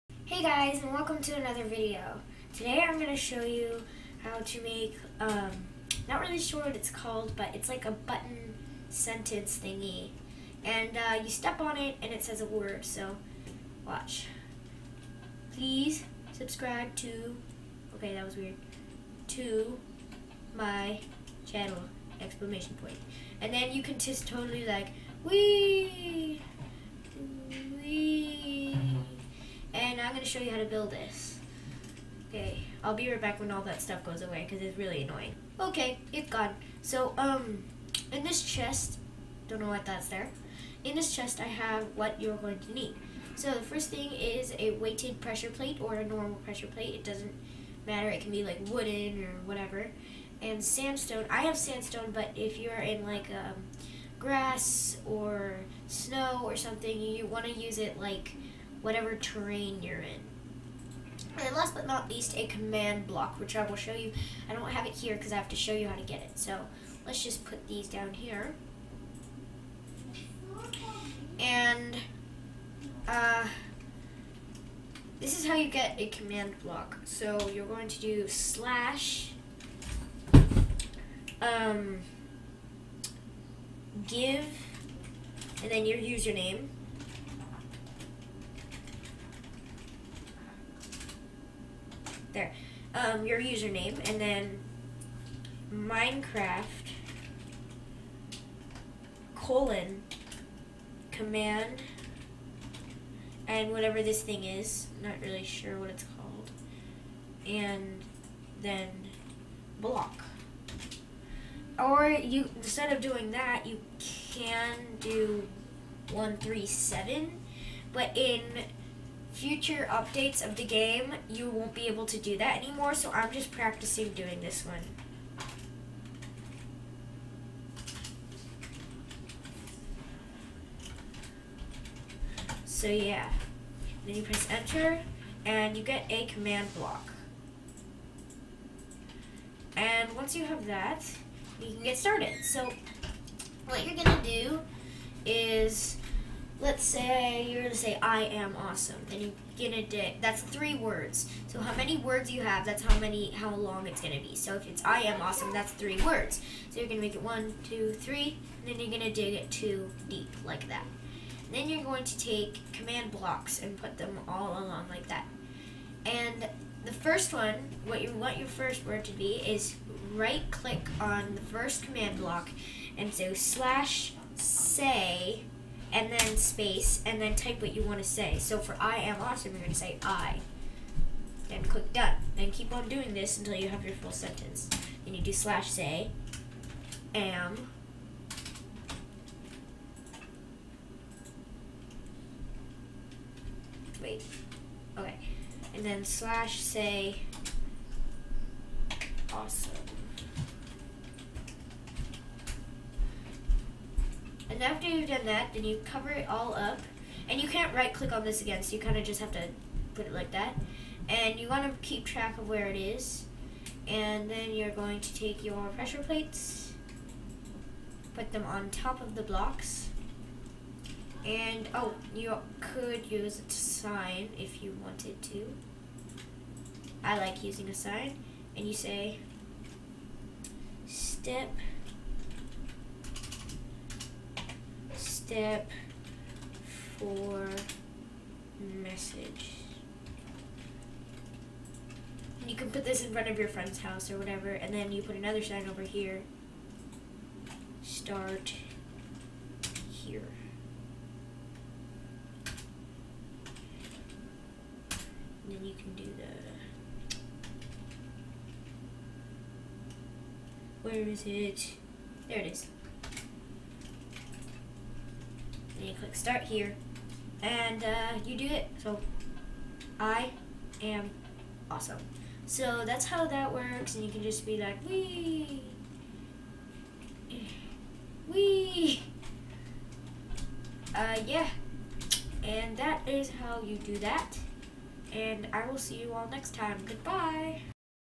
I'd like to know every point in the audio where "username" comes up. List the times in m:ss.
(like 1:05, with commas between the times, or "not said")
1:25, 1:33.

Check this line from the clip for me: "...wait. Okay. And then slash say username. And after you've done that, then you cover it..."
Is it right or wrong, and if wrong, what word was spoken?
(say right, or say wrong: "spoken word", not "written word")
wrong: "awesome", not "username".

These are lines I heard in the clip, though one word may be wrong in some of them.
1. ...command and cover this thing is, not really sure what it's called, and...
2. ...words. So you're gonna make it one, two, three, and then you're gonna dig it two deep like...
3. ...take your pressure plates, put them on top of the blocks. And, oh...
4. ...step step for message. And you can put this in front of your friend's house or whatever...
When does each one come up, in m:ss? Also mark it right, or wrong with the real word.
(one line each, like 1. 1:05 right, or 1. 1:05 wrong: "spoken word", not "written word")
1. 1:41 wrong: "whatever", not "cover"
2. 2:36 right
3. 3:35 right
4. 3:50 right.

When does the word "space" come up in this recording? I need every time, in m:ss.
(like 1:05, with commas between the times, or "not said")
2:56.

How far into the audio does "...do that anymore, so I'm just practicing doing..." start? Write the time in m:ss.
2:02.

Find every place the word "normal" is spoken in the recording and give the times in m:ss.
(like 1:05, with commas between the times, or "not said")
0:46.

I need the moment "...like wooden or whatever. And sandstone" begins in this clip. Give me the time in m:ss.
0:48.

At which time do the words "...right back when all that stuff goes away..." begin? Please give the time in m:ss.
0:33.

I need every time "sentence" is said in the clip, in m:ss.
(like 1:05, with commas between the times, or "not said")
0:08, 3:04.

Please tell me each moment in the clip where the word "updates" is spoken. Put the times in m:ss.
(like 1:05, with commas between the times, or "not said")
1:59.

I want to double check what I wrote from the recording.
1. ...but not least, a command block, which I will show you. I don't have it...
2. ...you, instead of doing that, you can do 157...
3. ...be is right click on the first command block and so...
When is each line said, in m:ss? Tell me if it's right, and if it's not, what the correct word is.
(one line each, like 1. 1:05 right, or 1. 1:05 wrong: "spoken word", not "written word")
1. 1:01 right
2. 1:52 wrong: "137", not "157"
3. 2:49 right.